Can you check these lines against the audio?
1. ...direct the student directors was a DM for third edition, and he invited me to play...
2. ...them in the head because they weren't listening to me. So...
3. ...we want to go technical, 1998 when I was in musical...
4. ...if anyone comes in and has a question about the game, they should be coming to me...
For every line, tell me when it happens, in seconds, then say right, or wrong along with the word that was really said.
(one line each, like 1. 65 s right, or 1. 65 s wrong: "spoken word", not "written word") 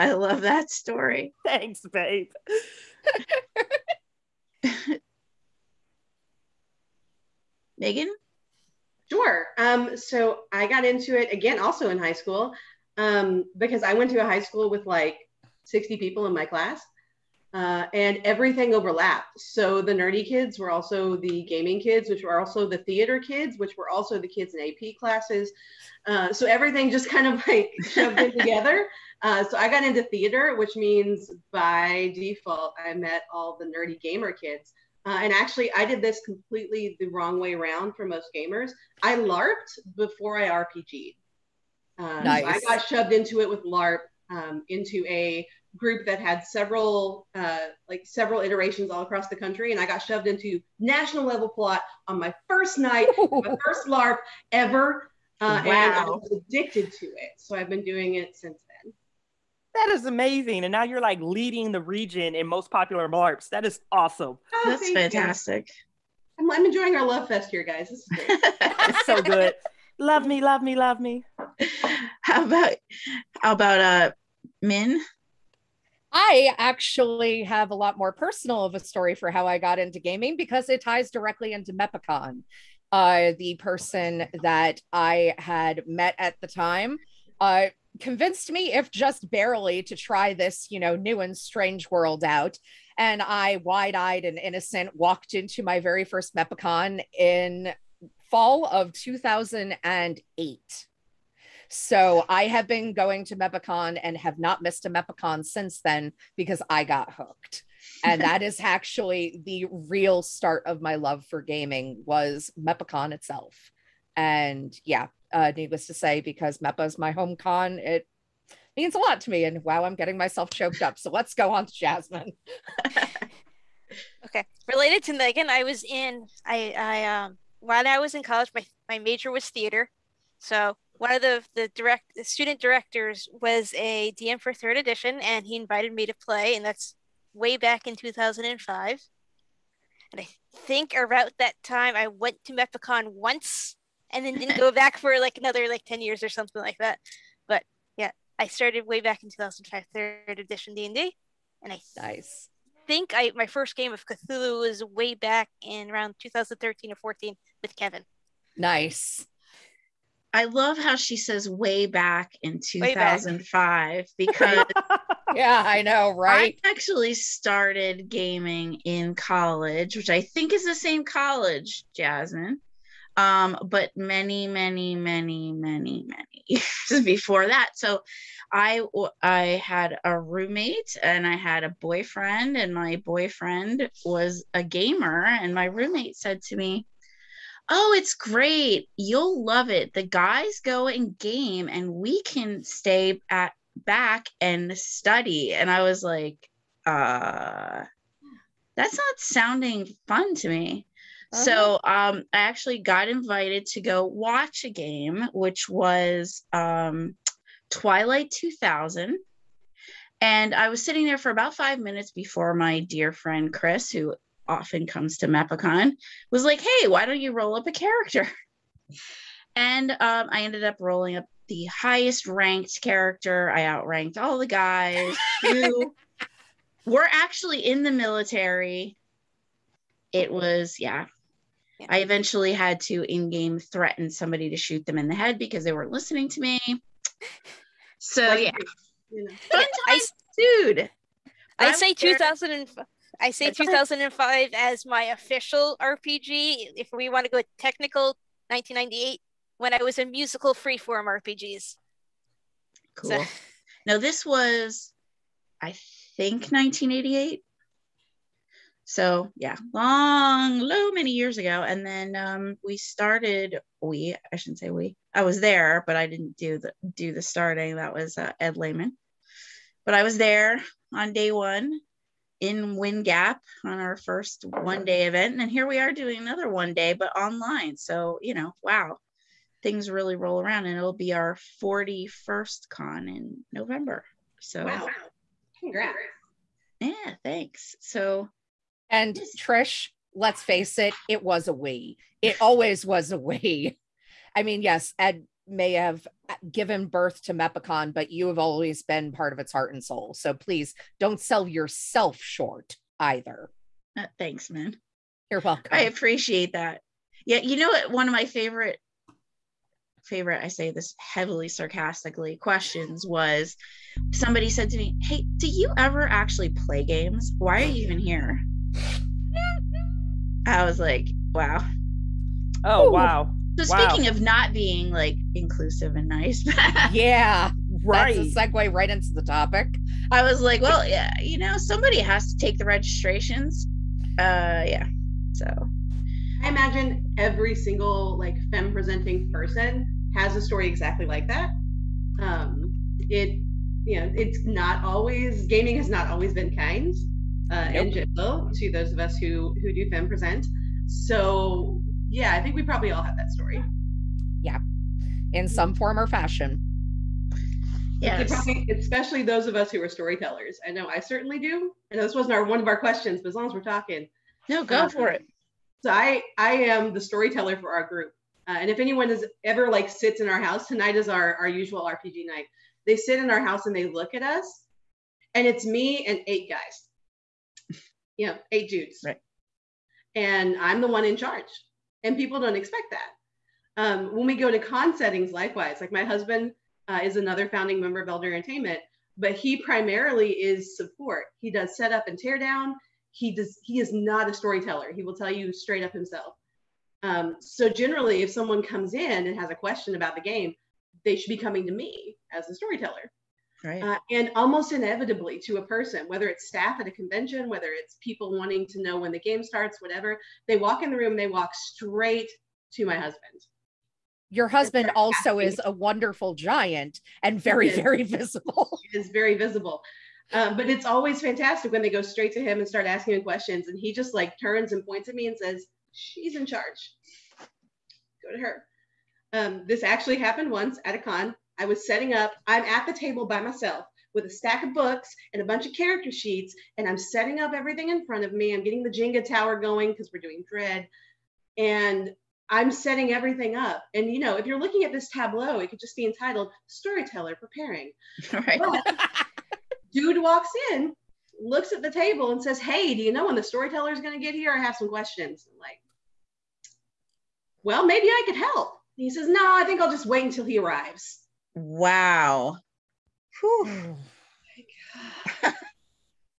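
1. 131 s right
2. 234 s right
3. 246 s right
4. 398 s wrong: "someone", not "anyone".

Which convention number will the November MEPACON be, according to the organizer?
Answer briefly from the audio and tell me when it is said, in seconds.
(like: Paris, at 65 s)
41st, at 281 s.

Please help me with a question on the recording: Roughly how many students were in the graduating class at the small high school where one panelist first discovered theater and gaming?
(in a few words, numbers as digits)
60.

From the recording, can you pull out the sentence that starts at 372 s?
They sit in our house and they look at us, and it's me and eight guys.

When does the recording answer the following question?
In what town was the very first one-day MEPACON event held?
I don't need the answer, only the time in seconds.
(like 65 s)
272 s.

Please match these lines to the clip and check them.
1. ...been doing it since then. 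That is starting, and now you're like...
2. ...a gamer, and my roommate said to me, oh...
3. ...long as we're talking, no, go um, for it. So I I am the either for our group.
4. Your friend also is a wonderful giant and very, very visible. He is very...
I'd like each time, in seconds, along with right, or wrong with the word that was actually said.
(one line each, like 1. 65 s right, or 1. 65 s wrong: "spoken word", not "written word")
1. 57 s wrong: "amazing", not "starting"
2. 184 s right
3. 363 s wrong: "storyteller", not "either"
4. 414 s wrong: "husband", not "friend".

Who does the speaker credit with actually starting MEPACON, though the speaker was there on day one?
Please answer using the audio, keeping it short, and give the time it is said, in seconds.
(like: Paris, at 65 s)
Ed Lehman, at 268 s.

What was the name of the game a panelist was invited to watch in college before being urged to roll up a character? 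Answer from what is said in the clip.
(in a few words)
Twilight 2000.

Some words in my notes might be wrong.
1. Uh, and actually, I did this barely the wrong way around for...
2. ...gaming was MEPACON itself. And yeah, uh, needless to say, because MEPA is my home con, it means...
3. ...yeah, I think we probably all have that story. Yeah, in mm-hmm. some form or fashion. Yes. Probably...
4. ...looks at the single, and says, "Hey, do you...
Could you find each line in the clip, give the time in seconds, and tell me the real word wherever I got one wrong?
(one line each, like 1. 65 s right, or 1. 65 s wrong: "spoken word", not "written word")
1. 35 s wrong: "completely", not "barely"
2. 111 s right
3. 352 s right
4. 451 s wrong: "table", not "single".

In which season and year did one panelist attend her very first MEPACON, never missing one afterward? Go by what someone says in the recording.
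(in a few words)
fall of 2008.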